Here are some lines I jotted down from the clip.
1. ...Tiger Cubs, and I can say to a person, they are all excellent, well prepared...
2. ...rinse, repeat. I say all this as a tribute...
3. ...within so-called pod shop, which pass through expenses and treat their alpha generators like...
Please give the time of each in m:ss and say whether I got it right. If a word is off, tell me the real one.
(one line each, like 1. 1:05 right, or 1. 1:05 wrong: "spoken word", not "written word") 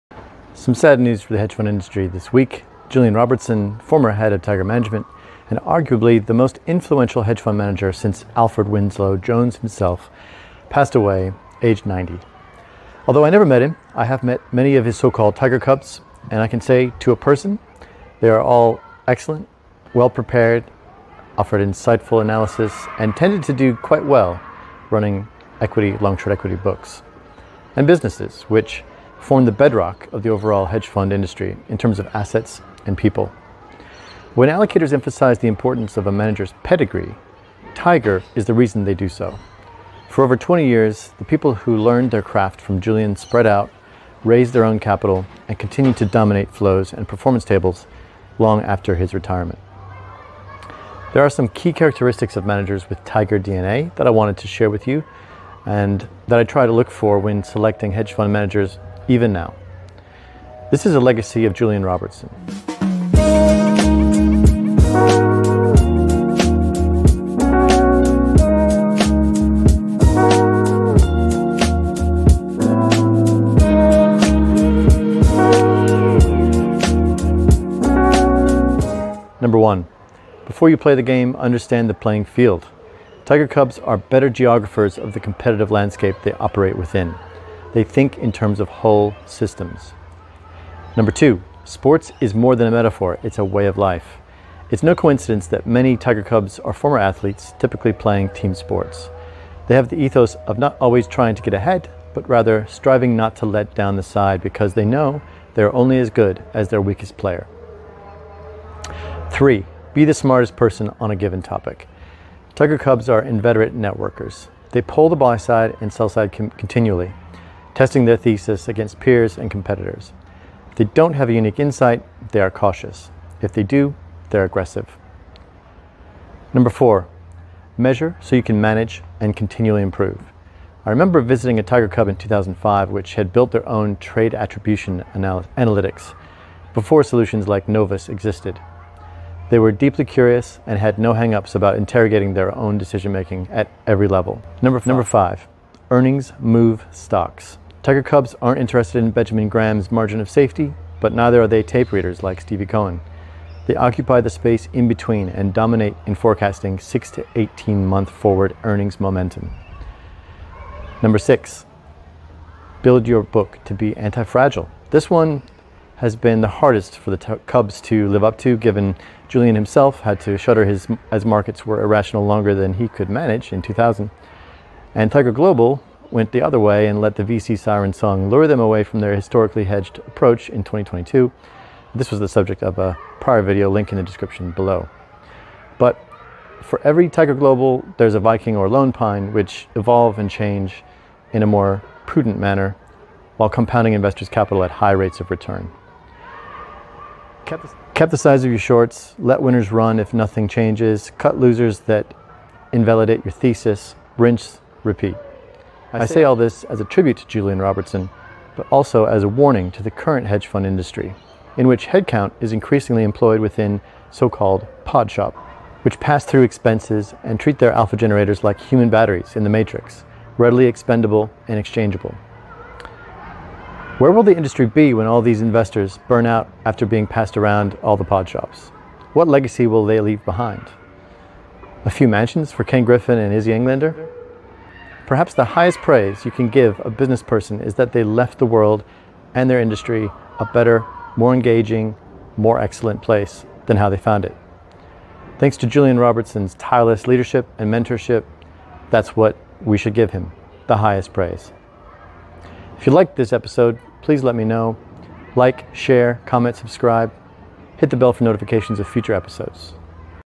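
1. 0:15 right
2. 3:24 right
3. 3:33 right.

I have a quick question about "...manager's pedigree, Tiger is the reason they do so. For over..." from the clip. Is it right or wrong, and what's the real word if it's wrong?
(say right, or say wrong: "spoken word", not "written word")
right.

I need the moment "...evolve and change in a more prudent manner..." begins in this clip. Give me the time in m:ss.
3:09.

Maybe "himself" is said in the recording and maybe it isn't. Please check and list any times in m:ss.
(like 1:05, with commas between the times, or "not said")
0:09, 2:49.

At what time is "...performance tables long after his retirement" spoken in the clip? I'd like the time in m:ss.
0:47.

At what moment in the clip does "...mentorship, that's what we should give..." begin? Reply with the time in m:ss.
4:07.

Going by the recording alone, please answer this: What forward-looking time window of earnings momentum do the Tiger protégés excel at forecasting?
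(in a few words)
6 to 18 months.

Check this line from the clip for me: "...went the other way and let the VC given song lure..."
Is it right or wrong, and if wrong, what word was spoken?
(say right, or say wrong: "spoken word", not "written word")
wrong: "siren", not "given".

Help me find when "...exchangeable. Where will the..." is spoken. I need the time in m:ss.
3:41.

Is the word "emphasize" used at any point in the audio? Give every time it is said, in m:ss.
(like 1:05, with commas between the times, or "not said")
0:34.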